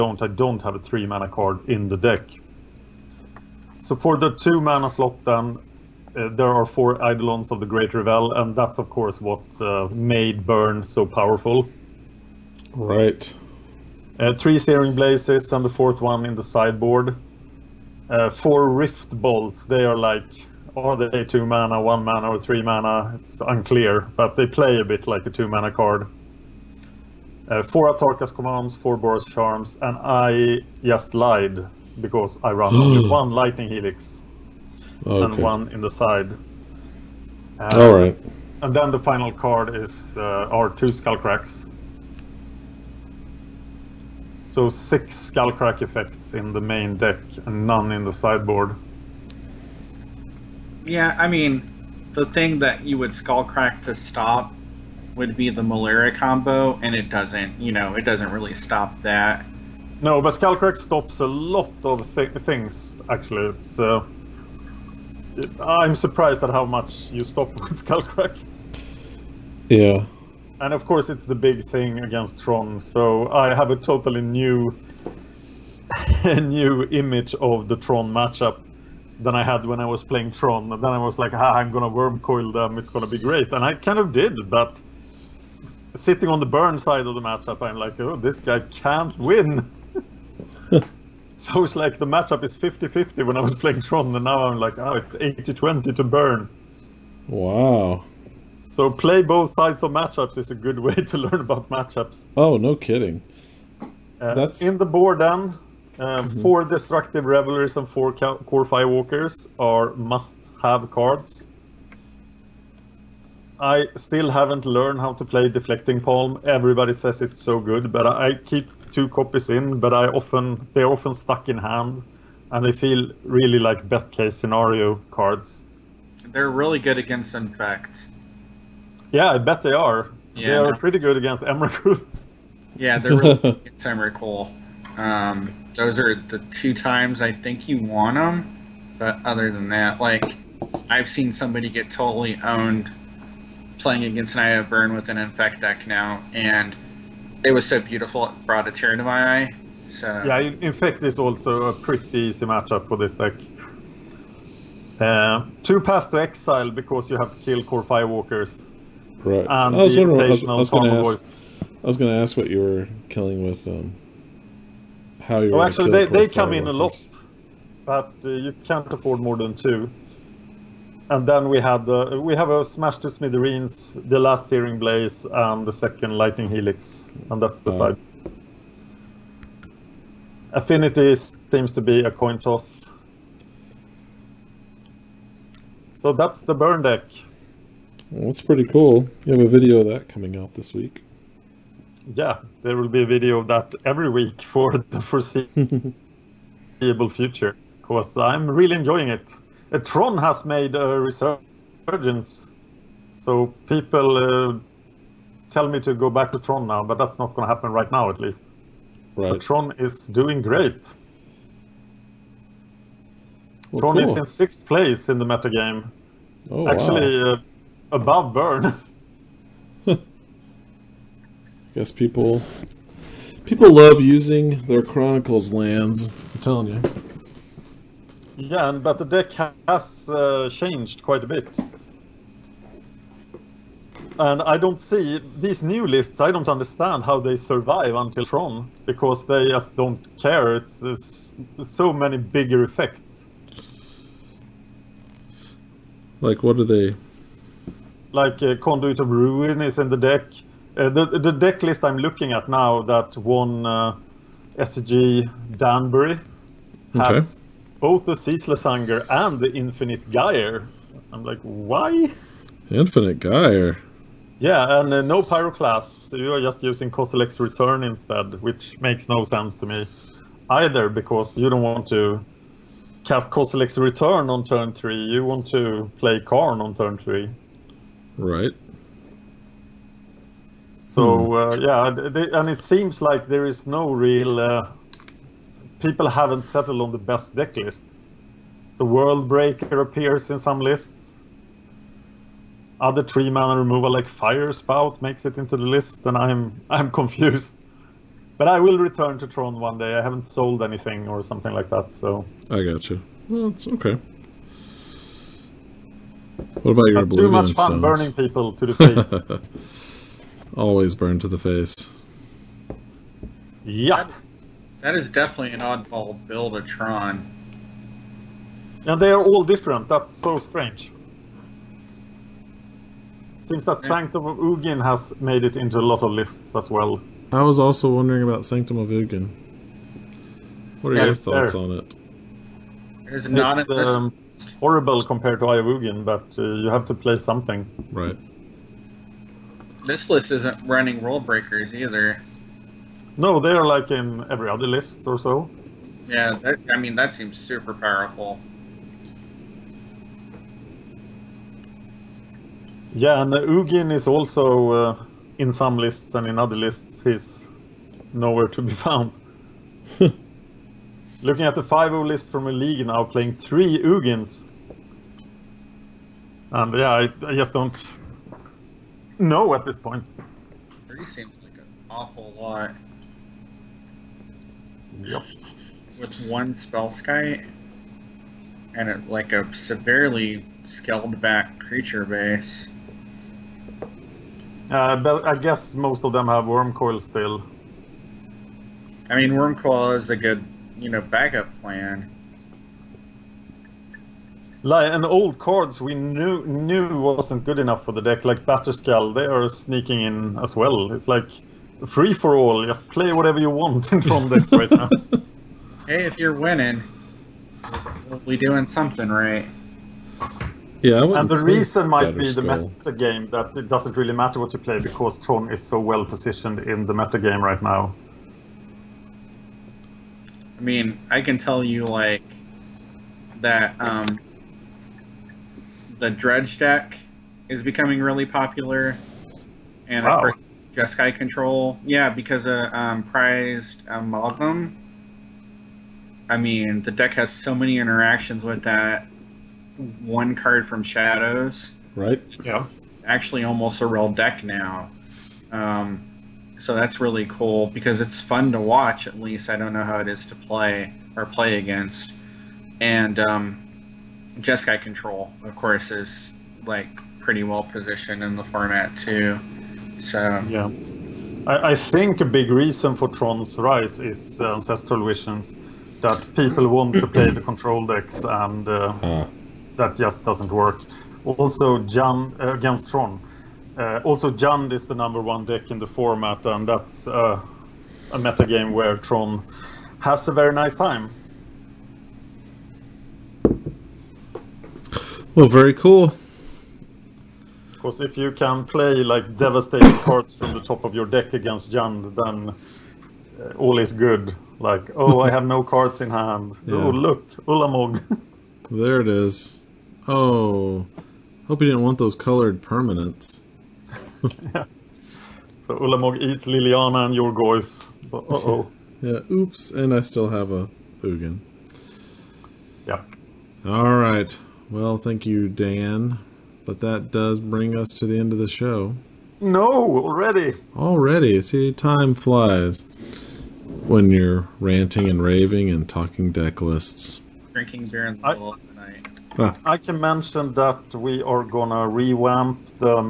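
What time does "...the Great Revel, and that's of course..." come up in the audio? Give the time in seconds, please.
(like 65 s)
7 s.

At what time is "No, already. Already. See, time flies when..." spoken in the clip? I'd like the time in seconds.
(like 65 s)
519 s.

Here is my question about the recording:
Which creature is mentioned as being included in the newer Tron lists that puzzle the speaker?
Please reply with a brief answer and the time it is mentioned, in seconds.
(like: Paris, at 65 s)
Conduit of Ruin, at 248 s.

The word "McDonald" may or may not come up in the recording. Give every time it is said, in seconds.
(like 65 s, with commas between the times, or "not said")
not said.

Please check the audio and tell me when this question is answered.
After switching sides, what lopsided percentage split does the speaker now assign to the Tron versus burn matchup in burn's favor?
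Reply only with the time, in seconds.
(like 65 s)
95 s.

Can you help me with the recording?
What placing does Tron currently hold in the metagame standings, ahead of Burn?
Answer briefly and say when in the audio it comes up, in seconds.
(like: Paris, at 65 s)
Sixth place, at 214 s.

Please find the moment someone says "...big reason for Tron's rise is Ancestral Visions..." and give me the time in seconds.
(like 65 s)
462 s.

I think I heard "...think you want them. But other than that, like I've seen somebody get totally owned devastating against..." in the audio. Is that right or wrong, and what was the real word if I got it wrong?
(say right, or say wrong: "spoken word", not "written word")
wrong: "playing", not "devastating".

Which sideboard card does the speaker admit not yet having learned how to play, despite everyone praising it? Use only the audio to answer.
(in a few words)
Deflecting Palm.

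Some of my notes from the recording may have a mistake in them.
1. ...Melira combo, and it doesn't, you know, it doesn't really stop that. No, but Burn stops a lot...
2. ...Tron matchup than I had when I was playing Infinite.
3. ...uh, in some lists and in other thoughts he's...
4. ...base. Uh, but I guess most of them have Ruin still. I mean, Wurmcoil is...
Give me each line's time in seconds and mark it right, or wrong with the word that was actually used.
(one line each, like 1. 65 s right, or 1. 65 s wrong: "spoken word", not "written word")
1. 55 s wrong: "Skullcrack", not "Burn"
2. 77 s wrong: "Tron", not "Infinite"
3. 354 s wrong: "lists", not "thoughts"
4. 382 s wrong: "Wurmcoil", not "Ruin".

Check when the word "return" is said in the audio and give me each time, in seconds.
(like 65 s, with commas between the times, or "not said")
267 s, 273 s, 298 s.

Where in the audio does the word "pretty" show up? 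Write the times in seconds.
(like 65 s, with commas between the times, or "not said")
130 s, 151 s, 188 s, 457 s.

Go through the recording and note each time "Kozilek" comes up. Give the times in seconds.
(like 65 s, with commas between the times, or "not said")
266 s, 273 s.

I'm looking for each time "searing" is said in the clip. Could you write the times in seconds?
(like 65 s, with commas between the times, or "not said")
14 s, 174 s.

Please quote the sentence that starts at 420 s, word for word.
I mean, I can tell you like that um, the dredge deck is becoming really popular, and wow.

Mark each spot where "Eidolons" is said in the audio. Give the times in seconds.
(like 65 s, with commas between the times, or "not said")
6 s.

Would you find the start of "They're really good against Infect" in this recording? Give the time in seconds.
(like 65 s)
126 s.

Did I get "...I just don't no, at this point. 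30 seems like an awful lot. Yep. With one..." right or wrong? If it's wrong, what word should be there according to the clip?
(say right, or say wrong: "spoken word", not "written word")
right.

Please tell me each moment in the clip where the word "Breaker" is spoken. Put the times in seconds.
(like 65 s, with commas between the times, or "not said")
289 s, 341 s.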